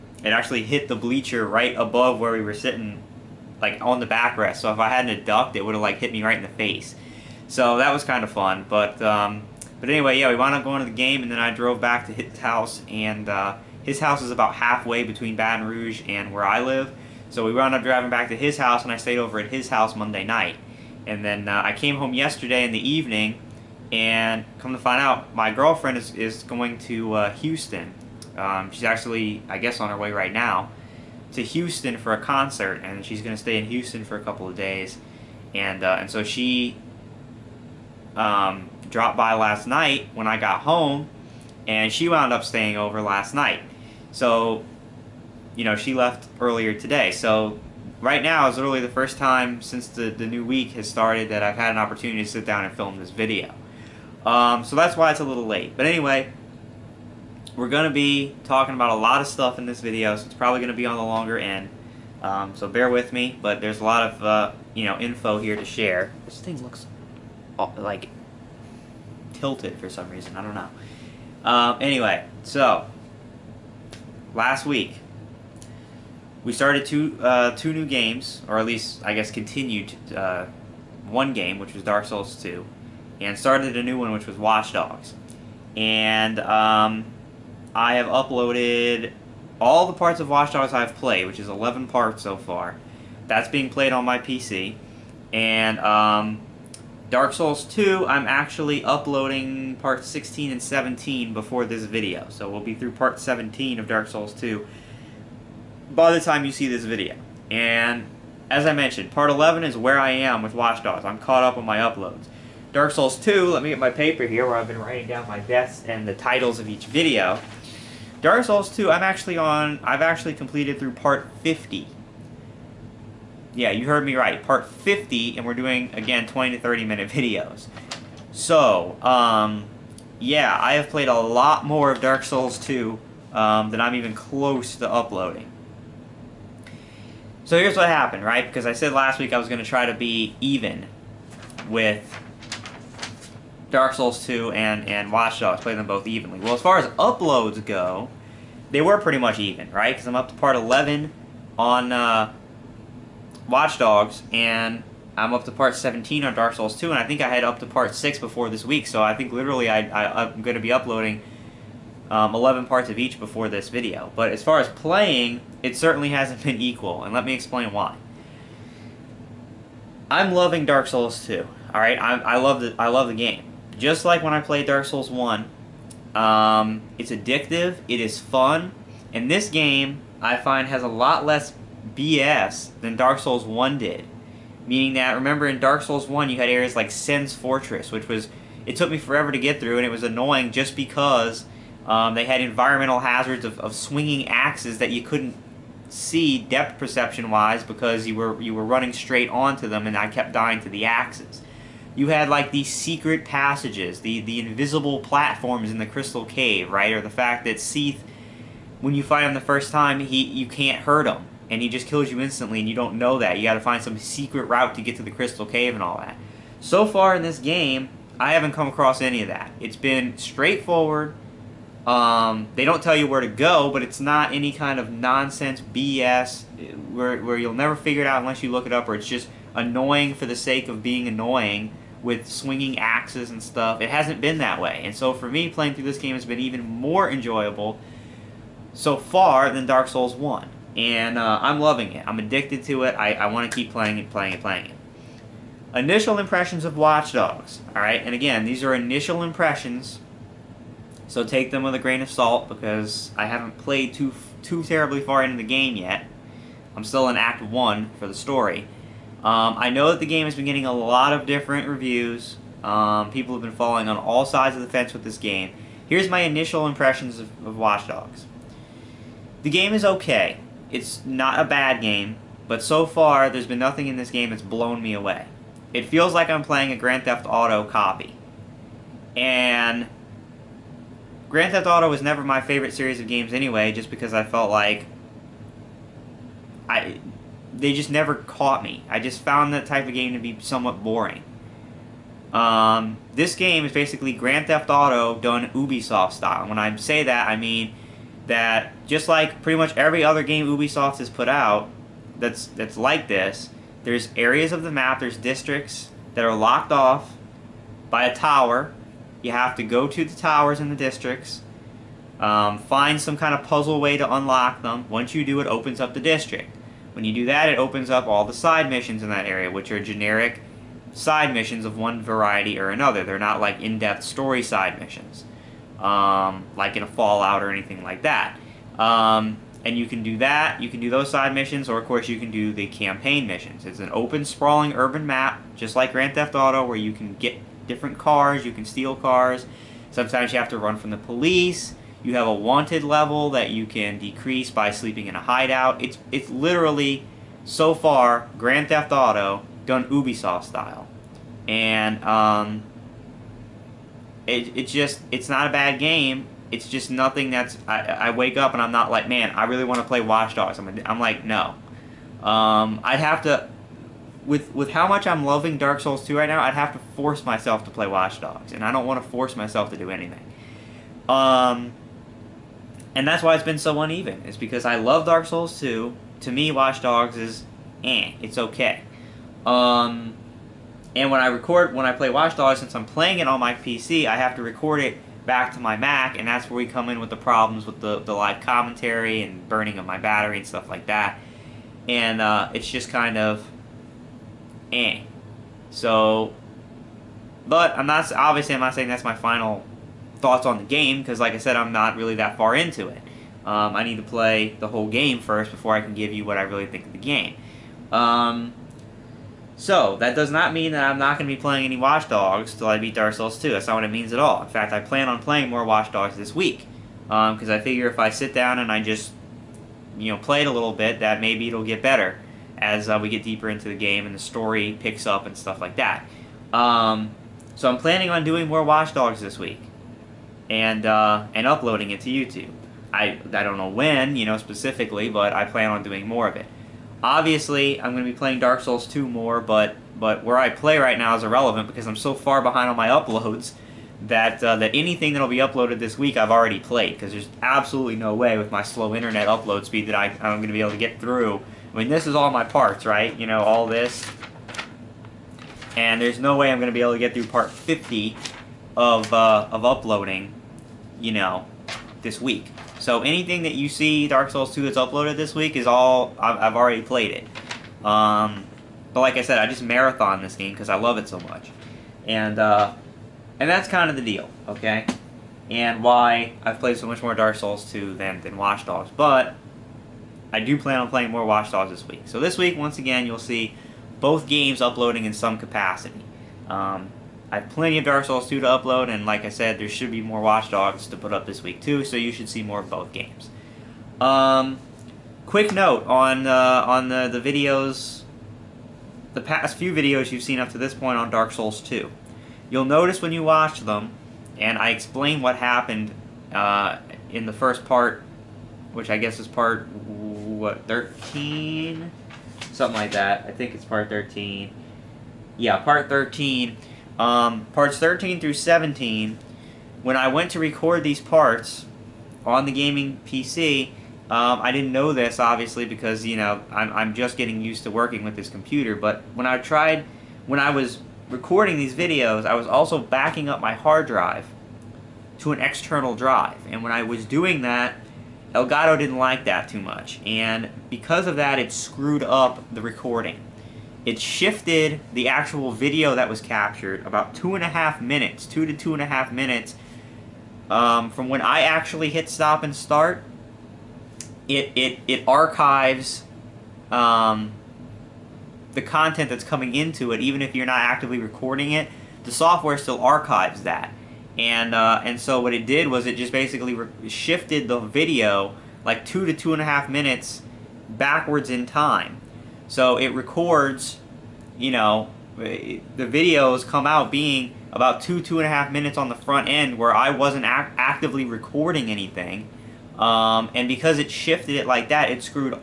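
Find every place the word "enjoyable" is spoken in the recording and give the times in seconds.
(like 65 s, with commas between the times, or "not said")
237 s.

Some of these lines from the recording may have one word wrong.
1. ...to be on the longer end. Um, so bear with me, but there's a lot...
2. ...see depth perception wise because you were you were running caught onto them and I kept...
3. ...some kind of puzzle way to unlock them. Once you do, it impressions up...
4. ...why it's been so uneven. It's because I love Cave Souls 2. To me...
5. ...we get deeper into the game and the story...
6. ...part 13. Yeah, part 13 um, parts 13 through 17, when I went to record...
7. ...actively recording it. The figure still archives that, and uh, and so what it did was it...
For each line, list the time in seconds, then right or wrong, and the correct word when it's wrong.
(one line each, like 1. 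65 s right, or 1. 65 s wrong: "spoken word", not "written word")
1. 60 s right
2. 195 s wrong: "straight", not "caught"
3. 313 s wrong: "opens", not "impressions"
4. 373 s wrong: "Dark", not "Cave"
5. 423 s right
6. 513 s right
7. 560 s wrong: "software", not "figure".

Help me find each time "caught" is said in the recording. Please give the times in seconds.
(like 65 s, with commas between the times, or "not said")
111 s, 288 s.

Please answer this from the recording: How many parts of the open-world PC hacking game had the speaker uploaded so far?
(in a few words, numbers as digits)
11.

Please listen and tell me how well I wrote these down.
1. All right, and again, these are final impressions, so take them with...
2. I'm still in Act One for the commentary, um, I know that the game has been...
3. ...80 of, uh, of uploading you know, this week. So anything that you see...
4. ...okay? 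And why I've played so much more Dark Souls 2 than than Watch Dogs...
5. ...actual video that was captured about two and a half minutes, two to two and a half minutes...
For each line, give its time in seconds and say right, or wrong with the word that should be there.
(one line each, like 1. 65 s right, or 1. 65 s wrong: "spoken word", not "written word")
1. 247 s wrong: "initial", not "final"
2. 256 s wrong: "story", not "commentary"
3. 457 s wrong: "50", not "80"
4. 474 s right
5. 545 s right.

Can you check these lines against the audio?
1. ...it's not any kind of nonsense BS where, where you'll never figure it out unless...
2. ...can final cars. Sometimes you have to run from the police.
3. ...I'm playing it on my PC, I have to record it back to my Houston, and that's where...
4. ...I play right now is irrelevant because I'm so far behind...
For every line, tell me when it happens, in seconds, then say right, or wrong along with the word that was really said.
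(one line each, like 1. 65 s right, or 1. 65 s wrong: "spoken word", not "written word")
1. 223 s right
2. 338 s wrong: "steal", not "final"
3. 382 s wrong: "Mac", not "Houston"
4. 440 s right.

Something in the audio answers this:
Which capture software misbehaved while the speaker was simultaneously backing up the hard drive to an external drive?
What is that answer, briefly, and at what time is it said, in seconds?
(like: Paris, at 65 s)
Elgato, at 538 s.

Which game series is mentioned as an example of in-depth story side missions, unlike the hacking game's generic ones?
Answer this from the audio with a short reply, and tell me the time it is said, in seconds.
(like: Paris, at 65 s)
Fallout, at 326 s.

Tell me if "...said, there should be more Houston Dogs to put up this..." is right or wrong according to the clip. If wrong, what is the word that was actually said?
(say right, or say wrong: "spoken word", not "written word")
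wrong: "Watch", not "Houston".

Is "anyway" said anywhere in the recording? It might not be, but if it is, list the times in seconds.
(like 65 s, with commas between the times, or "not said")
9 s, 55 s, 71 s, 283 s.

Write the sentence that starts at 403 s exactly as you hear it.
Um, I need to play the whole game first before I can give you what I really think of the game.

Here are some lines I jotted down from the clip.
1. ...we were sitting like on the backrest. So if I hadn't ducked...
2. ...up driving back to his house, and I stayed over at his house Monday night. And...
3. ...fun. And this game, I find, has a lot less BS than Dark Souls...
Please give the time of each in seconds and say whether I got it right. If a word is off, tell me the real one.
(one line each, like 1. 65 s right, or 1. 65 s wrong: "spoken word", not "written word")
1. 2 s right
2. 17 s right
3. 178 s right.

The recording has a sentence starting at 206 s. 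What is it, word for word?
Or the fact that Seath, when you fight him the first time, he you can't hurt him.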